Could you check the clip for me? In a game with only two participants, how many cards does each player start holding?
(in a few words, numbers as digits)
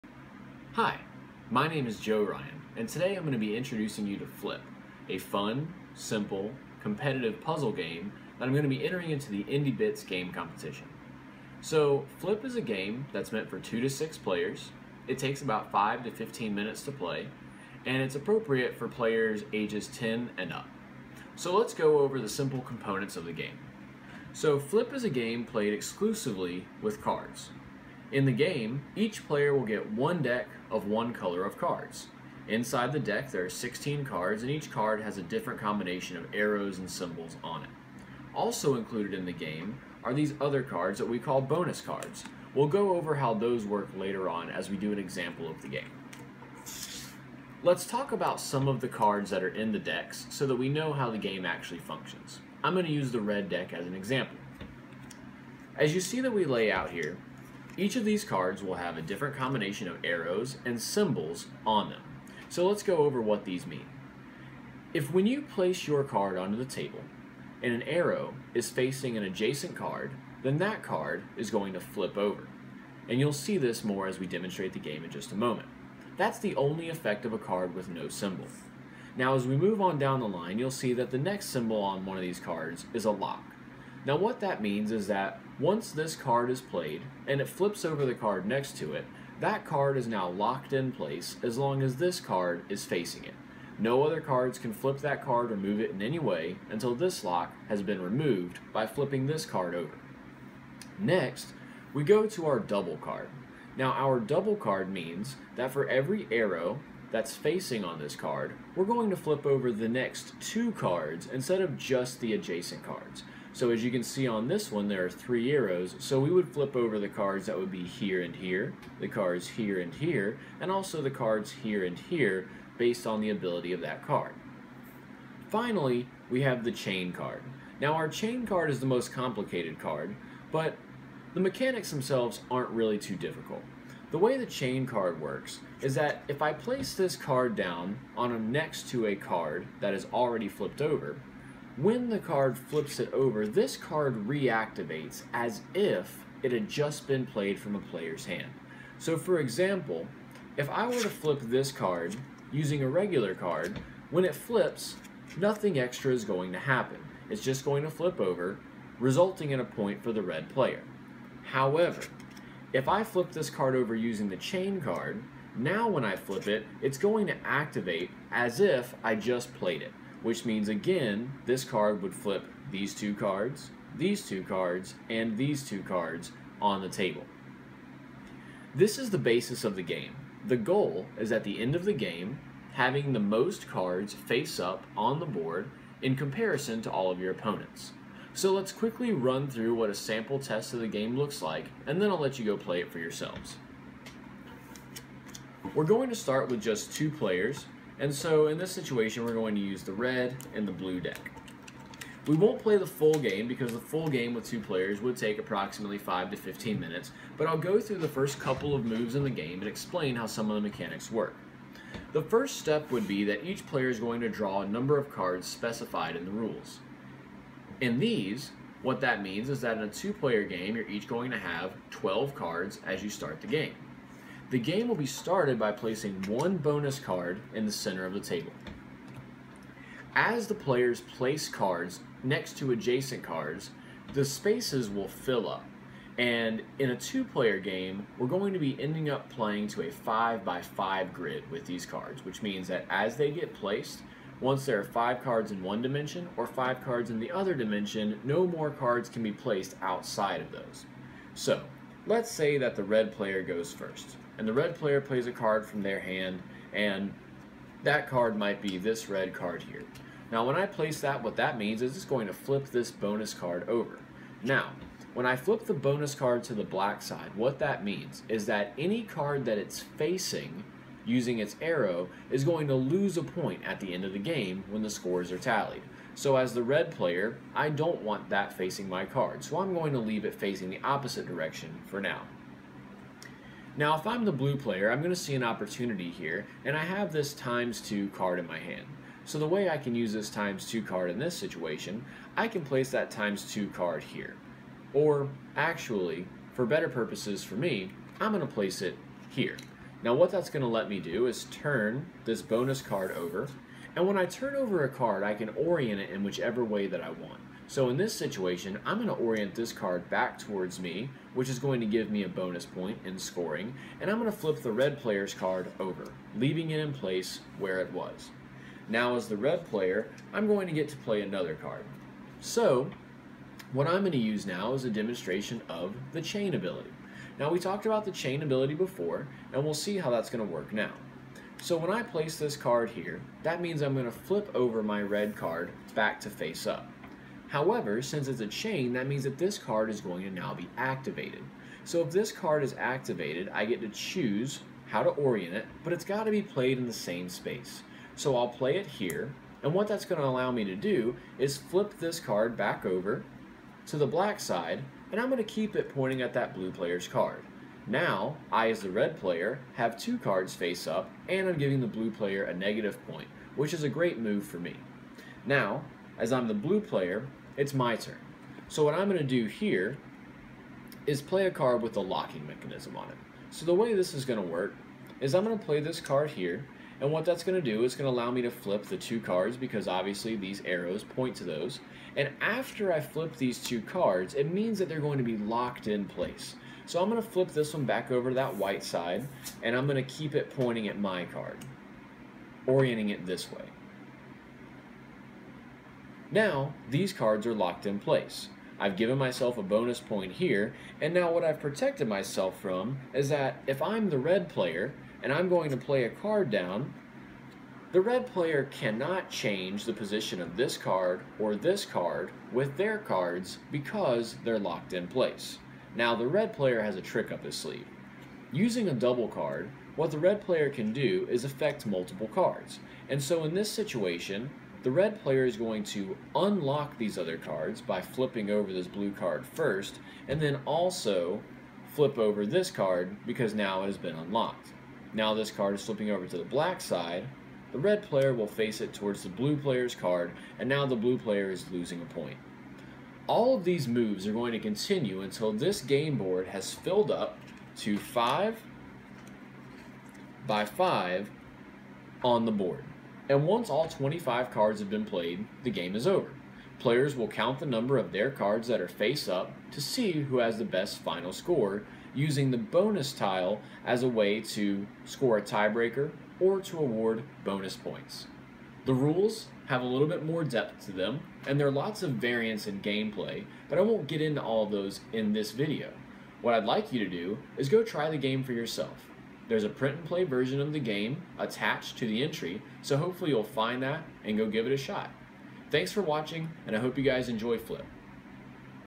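12.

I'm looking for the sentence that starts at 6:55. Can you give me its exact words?
Now the red player has a trick up his sleeve.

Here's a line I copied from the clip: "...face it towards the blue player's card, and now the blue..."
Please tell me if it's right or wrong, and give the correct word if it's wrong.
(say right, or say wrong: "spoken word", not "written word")
right.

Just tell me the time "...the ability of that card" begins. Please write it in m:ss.
2:03.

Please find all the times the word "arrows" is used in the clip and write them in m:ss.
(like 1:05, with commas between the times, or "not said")
0:36, 1:00, 1:07, 1:46, 1:55, 4:31, 6:20.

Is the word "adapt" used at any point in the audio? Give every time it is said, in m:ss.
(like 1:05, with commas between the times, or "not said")
not said.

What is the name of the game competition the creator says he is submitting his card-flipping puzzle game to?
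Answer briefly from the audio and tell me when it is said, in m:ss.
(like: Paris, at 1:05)
Indie Bits, at 0:09.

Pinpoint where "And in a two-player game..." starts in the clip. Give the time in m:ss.
3:56.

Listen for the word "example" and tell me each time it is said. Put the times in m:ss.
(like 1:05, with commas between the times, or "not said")
0:44, 0:53, 2:29.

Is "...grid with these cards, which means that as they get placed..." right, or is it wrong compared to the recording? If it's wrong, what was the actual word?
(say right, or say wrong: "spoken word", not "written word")
right.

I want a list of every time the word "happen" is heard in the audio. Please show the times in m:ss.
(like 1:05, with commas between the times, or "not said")
2:36.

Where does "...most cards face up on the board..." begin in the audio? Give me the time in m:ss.
3:03.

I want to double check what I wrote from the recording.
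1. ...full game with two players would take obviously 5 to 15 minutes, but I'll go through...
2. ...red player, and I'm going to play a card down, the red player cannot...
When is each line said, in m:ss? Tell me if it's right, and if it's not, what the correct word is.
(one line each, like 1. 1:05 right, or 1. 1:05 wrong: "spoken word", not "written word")
1. 3:23 wrong: "approximately", not "obviously"
2. 6:44 right.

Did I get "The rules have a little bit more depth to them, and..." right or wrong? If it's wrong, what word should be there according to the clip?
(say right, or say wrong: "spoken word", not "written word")
right.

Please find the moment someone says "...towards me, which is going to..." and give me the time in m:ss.
5:10.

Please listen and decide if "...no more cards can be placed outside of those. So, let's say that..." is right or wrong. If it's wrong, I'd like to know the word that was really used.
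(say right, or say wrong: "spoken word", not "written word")
right.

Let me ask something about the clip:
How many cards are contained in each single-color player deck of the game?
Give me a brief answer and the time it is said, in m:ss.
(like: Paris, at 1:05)
16, at 0:33.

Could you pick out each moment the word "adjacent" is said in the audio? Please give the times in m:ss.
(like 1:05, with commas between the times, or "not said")
1:09, 1:52, 3:52.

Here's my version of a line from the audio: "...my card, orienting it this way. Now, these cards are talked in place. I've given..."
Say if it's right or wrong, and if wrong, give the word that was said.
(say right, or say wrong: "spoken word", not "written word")
wrong: "locked", not "talked".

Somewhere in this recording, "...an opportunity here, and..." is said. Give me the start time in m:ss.
4:45.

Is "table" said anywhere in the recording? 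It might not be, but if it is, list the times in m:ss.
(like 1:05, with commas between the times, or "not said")
1:06, 2:56, 3:48.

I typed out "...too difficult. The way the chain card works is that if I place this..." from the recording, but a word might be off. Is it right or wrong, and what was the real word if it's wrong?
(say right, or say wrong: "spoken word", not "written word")
right.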